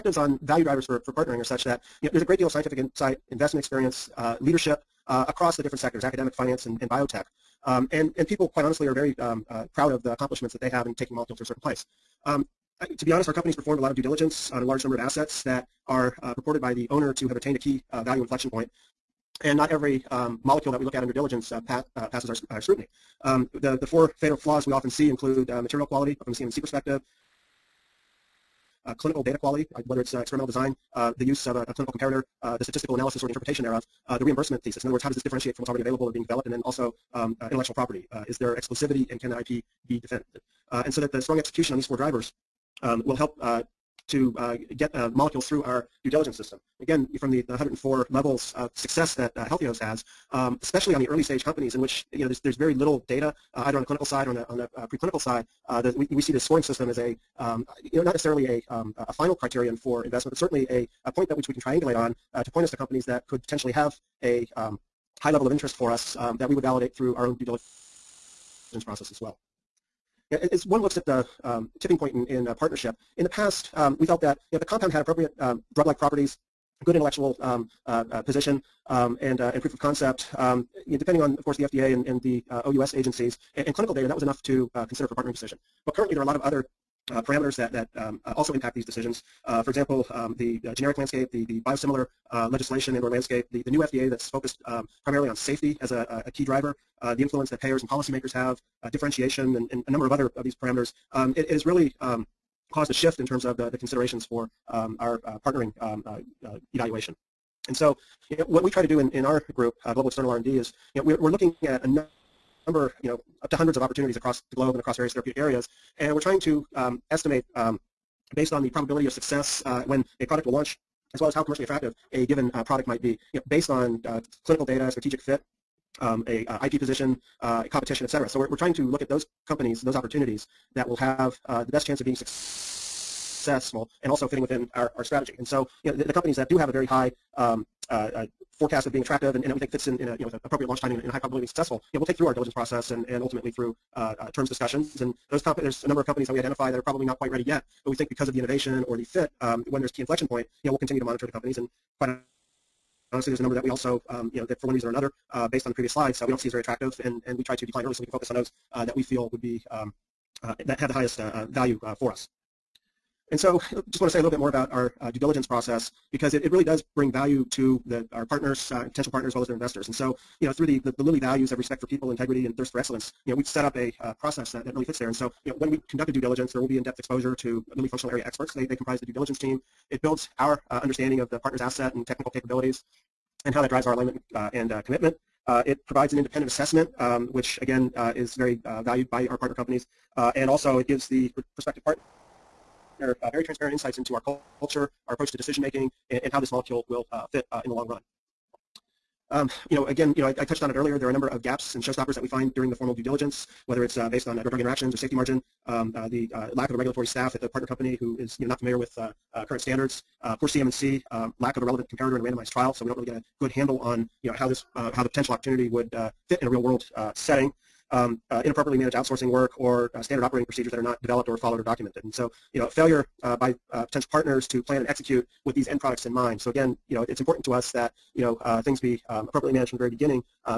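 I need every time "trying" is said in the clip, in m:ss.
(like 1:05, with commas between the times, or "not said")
1:56, 2:08.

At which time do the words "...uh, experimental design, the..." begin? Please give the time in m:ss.
0:30.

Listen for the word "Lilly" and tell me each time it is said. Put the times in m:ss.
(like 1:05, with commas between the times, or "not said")
2:51, 2:57.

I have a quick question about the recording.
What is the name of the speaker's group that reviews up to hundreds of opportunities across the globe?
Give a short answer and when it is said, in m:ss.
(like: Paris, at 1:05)
Global External R&D, at 1:49.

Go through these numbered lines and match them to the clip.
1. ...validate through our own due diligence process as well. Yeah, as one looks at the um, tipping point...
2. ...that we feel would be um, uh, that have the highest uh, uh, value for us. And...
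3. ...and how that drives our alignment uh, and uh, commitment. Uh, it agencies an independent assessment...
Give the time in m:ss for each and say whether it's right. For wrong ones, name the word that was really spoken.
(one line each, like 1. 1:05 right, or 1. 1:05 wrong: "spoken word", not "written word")
1. 1:06 right
2. 2:38 right
3. 3:03 wrong: "provides", not "agencies".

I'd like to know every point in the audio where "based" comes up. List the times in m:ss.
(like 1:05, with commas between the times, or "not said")
1:58, 2:03, 2:35, 3:24.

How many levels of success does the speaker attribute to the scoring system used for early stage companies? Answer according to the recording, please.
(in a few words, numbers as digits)
104.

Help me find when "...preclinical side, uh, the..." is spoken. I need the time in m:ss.
0:54.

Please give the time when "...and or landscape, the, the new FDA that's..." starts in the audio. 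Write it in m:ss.
1:32.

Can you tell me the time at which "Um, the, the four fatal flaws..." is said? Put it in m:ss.
0:23.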